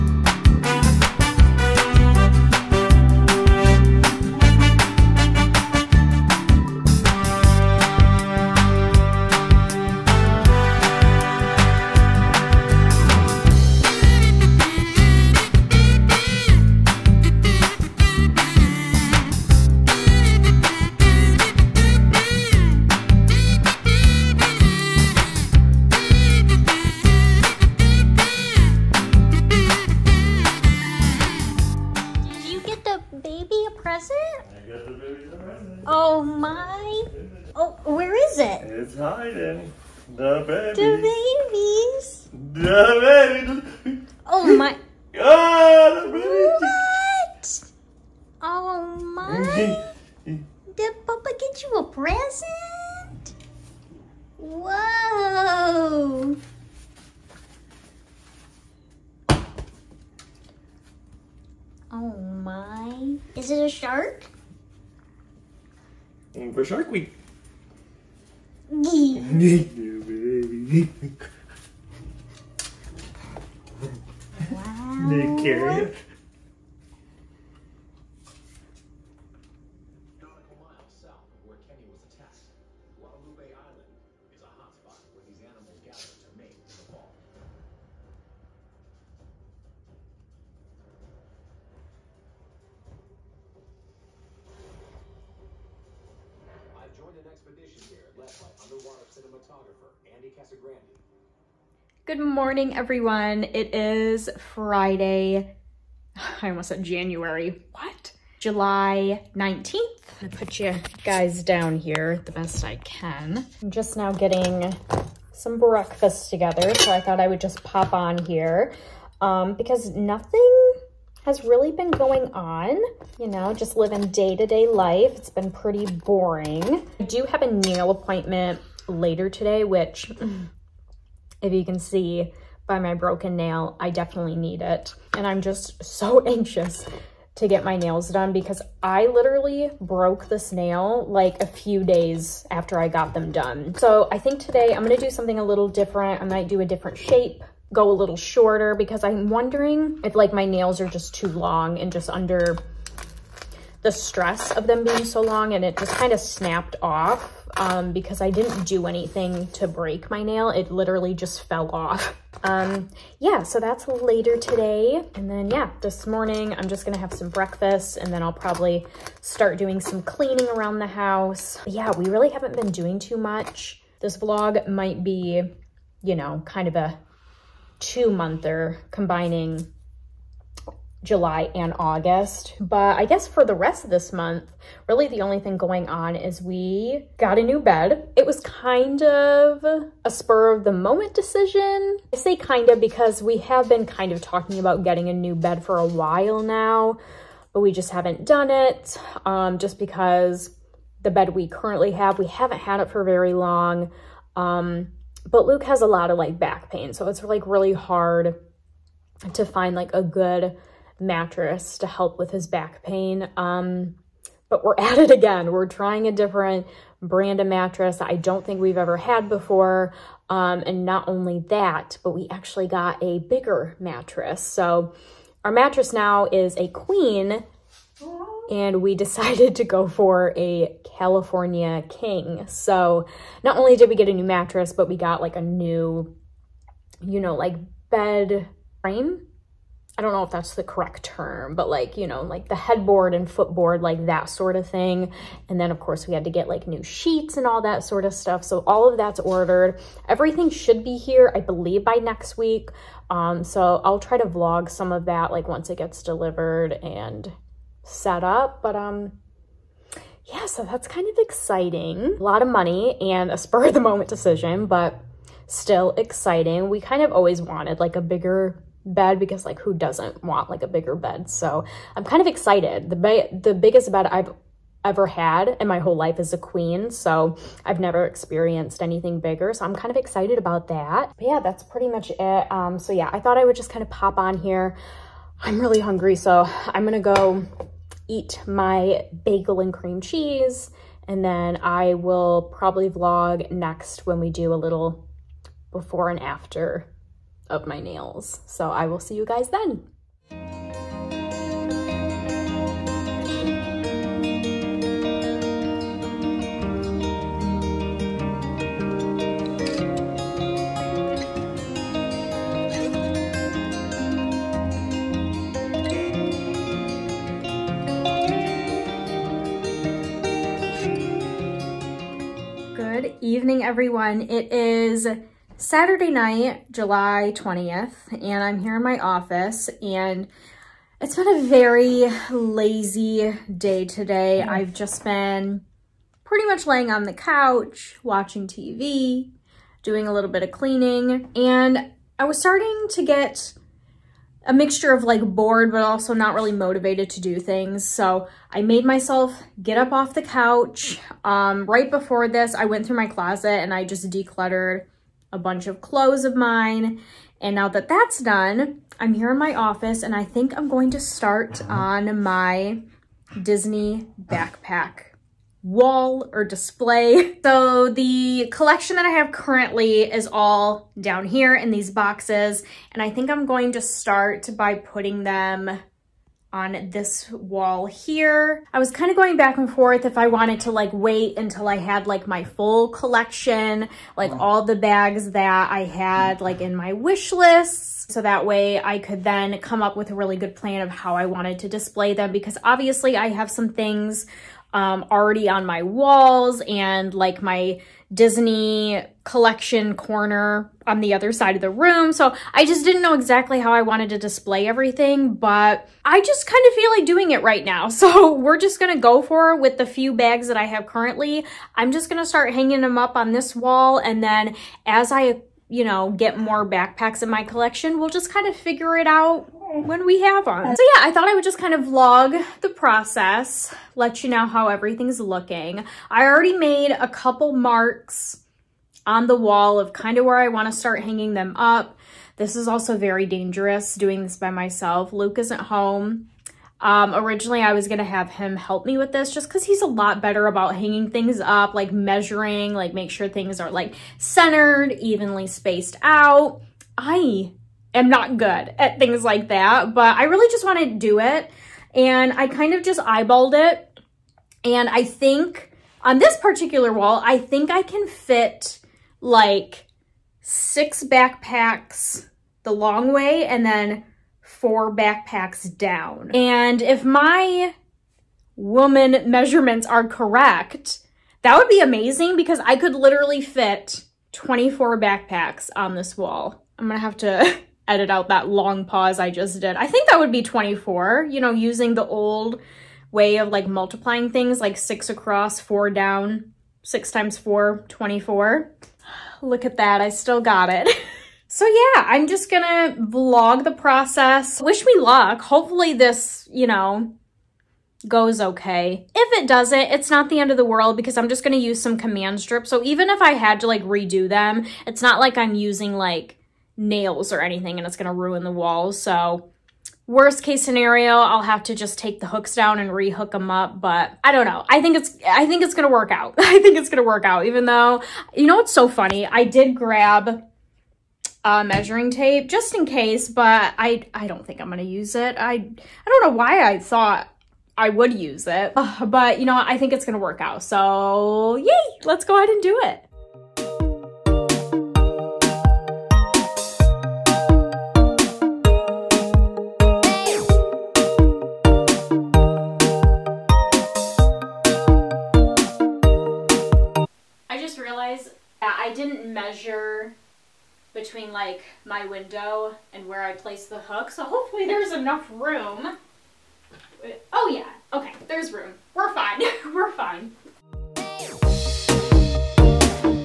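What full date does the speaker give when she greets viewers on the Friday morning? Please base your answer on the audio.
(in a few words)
July 19th.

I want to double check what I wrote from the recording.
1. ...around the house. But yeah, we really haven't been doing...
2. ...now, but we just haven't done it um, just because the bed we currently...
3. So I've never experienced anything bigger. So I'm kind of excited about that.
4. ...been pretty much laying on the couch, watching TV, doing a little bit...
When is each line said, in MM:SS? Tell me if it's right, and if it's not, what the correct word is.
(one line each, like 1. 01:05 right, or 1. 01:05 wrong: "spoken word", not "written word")
1. 02:50 right
2. 03:16 right
3. 04:36 right
4. 05:35 right.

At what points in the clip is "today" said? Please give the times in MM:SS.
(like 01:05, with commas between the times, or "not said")
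02:09, 02:24, 02:44, 05:33.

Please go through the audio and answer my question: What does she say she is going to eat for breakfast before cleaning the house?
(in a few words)
Bagel and cream cheese.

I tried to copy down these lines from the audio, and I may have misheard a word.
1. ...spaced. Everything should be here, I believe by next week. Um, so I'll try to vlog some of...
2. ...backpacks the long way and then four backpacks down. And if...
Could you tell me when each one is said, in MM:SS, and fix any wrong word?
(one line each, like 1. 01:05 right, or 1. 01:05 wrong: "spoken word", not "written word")
1. 04:09 wrong: "ordered", not "spaced"
2. 07:41 right.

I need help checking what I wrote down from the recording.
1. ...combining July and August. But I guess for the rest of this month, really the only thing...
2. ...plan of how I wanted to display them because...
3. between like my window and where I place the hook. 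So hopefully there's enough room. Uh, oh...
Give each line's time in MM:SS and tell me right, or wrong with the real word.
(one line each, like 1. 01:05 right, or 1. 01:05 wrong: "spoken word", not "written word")
1. 02:58 right
2. 06:30 right
3. 09:11 right.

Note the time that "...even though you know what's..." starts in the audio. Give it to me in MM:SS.
08:37.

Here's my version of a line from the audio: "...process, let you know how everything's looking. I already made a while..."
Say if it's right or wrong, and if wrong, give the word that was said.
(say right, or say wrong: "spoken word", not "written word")
wrong: "couple", not "while".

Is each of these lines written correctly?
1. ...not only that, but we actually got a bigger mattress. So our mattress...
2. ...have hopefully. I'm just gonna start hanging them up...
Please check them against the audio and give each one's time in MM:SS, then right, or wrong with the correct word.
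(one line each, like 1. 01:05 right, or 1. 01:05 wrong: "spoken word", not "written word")
1. 03:40 right
2. 06:50 wrong: "currently", not "hopefully".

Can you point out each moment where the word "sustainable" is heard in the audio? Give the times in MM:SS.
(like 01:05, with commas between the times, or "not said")
not said.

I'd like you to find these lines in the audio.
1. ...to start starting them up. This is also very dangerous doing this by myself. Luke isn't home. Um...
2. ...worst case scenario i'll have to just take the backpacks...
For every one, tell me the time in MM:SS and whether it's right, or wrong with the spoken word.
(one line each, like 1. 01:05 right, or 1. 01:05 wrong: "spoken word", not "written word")
1. 07:10 wrong: "hanging", not "starting"
2. 08:30 wrong: "hooks", not "backpacks".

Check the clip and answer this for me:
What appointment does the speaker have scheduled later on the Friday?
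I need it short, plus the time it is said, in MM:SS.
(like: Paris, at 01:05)
Nail appointment, at 02:07.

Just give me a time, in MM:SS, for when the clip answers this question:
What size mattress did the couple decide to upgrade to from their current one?
03:50.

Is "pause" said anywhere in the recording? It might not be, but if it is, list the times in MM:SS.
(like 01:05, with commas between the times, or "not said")
07:58.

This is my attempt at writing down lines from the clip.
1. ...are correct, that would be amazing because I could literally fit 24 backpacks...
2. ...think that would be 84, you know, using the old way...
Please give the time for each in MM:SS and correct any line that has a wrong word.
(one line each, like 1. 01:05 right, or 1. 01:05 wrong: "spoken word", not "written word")
1. 07:49 right
2. 07:59 wrong: "24", not "84".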